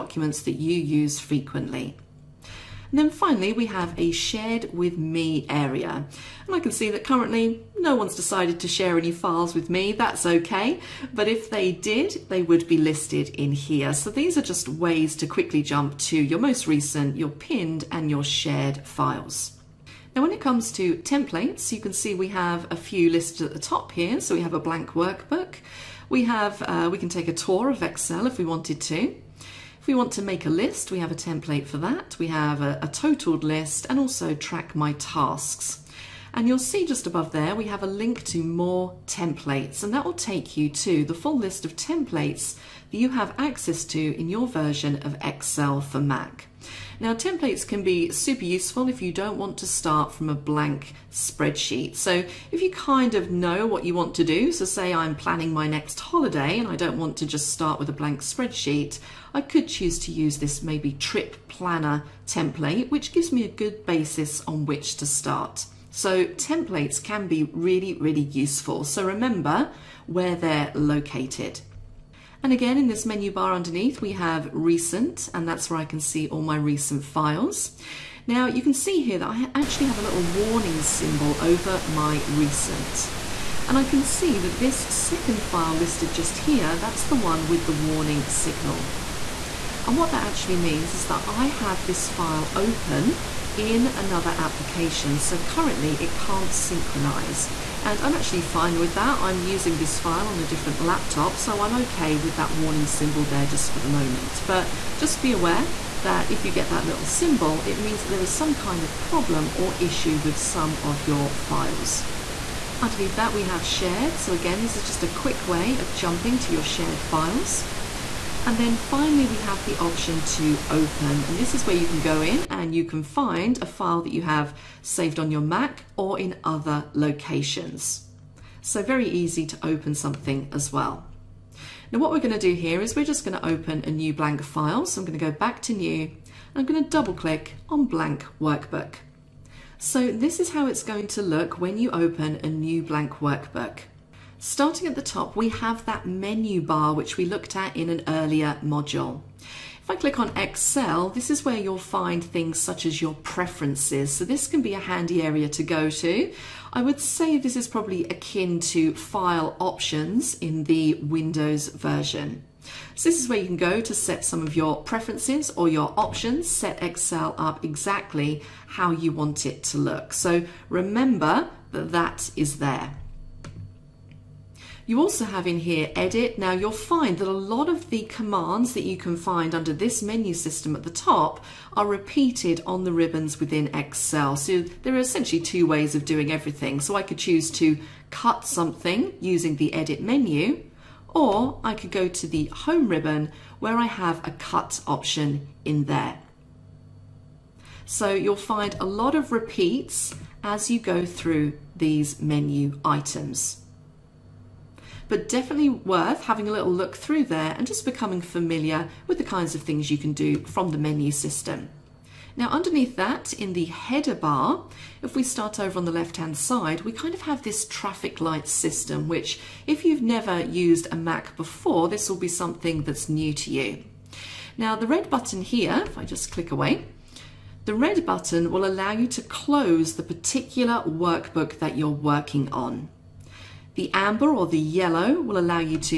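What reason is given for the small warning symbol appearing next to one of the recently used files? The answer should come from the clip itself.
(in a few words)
open in another application.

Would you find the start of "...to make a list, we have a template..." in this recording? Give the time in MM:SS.
00:30.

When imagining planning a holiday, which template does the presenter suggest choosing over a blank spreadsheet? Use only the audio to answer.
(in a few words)
trip planner.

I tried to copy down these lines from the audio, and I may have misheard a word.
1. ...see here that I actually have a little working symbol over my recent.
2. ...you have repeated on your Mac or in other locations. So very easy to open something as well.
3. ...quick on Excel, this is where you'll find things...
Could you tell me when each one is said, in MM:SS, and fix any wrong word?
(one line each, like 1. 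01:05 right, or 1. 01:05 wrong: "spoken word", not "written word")
1. 01:18 wrong: "warning", not "working"
2. 02:04 wrong: "saved", not "repeated"
3. 02:29 wrong: "click", not "quick".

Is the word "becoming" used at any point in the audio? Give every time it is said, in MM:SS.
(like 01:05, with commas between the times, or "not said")
03:27.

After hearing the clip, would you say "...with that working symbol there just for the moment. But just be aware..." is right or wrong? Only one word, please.
wrong.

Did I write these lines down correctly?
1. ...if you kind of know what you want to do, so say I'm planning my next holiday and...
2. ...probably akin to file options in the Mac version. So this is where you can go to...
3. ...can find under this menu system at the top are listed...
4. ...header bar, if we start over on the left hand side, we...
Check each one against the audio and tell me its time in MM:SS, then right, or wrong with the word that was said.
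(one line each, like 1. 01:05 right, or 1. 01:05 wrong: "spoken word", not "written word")
1. 00:52 right
2. 02:37 wrong: "Windows", not "Mac"
3. 02:58 wrong: "repeated", not "listed"
4. 03:33 right.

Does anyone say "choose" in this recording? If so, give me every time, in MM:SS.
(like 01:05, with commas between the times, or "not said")
00:59, 03:07.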